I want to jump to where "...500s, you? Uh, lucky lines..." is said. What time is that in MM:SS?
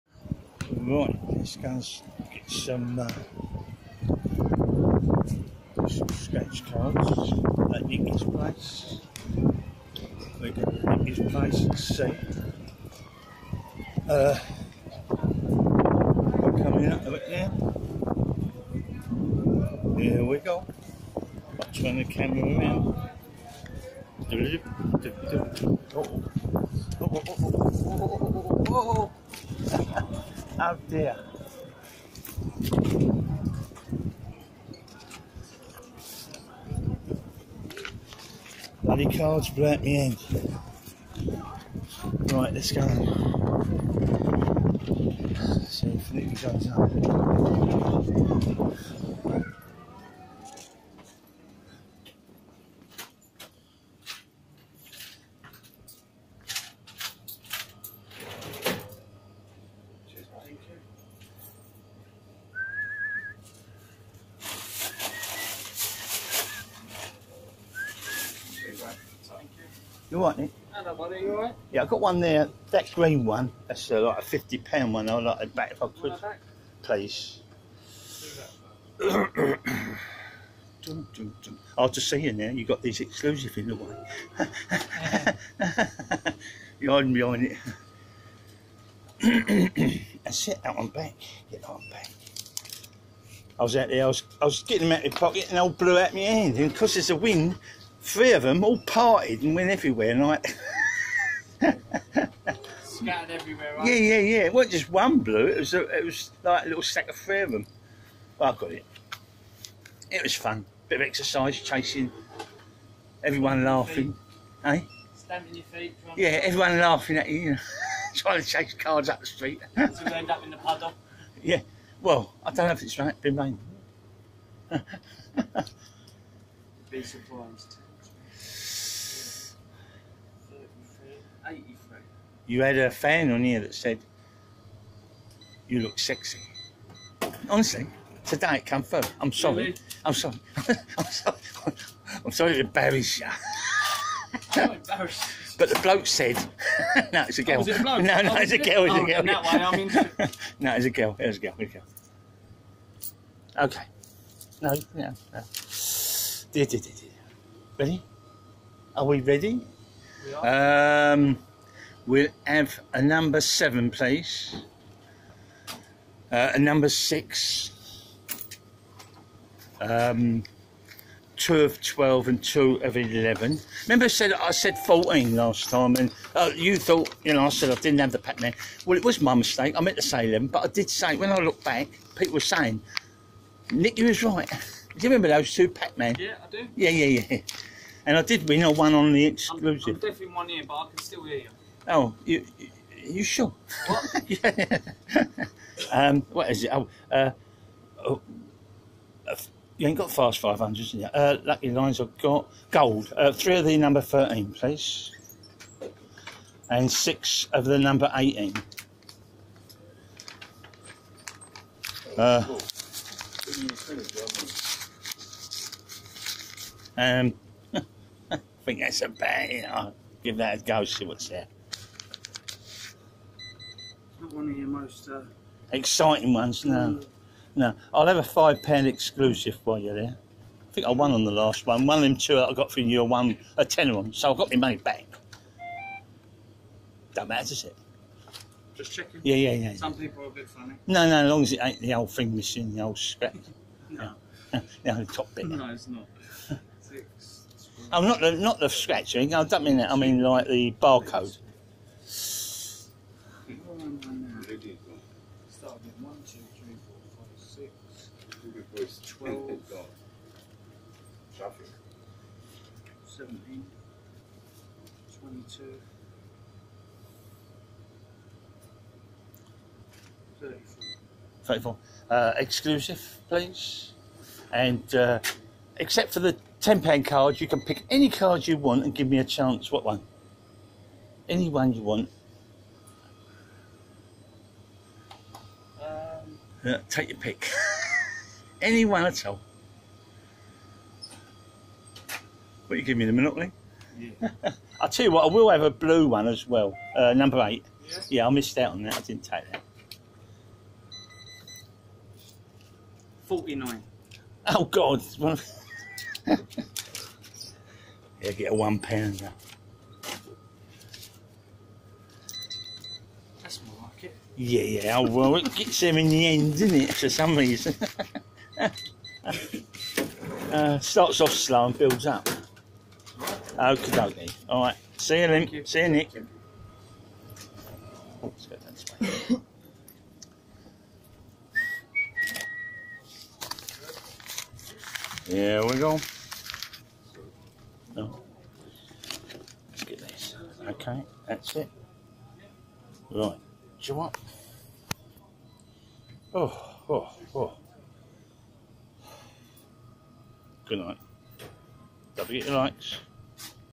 03:20.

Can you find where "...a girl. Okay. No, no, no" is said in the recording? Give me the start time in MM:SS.
02:31.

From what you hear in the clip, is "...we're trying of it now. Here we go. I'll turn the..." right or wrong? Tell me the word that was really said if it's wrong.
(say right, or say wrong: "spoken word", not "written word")
wrong: "coming", not "trying".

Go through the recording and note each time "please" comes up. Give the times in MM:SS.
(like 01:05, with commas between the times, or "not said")
01:16, 02:43, 03:24, 04:33.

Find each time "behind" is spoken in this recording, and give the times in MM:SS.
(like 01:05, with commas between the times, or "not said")
01:27.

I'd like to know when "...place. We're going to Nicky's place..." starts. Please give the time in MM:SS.
00:08.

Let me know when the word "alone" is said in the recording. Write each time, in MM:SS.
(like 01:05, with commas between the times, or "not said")
not said.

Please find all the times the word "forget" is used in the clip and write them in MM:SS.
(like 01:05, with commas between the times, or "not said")
05:52.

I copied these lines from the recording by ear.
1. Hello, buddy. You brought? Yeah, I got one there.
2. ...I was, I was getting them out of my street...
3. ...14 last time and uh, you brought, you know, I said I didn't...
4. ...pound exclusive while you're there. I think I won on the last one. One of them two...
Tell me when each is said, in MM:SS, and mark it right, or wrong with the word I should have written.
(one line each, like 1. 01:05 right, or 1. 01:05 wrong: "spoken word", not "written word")
1. 01:10 wrong: "alright", not "brought"
2. 01:34 wrong: "pocket", not "street"
3. 02:54 wrong: "thought", not "brought"
4. 03:48 right.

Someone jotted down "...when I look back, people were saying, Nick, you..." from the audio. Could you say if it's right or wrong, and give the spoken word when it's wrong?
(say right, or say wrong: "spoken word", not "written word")
right.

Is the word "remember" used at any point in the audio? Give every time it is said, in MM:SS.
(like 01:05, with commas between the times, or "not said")
02:53, 03:05.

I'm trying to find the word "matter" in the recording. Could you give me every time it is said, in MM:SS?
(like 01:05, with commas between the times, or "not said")
03:57.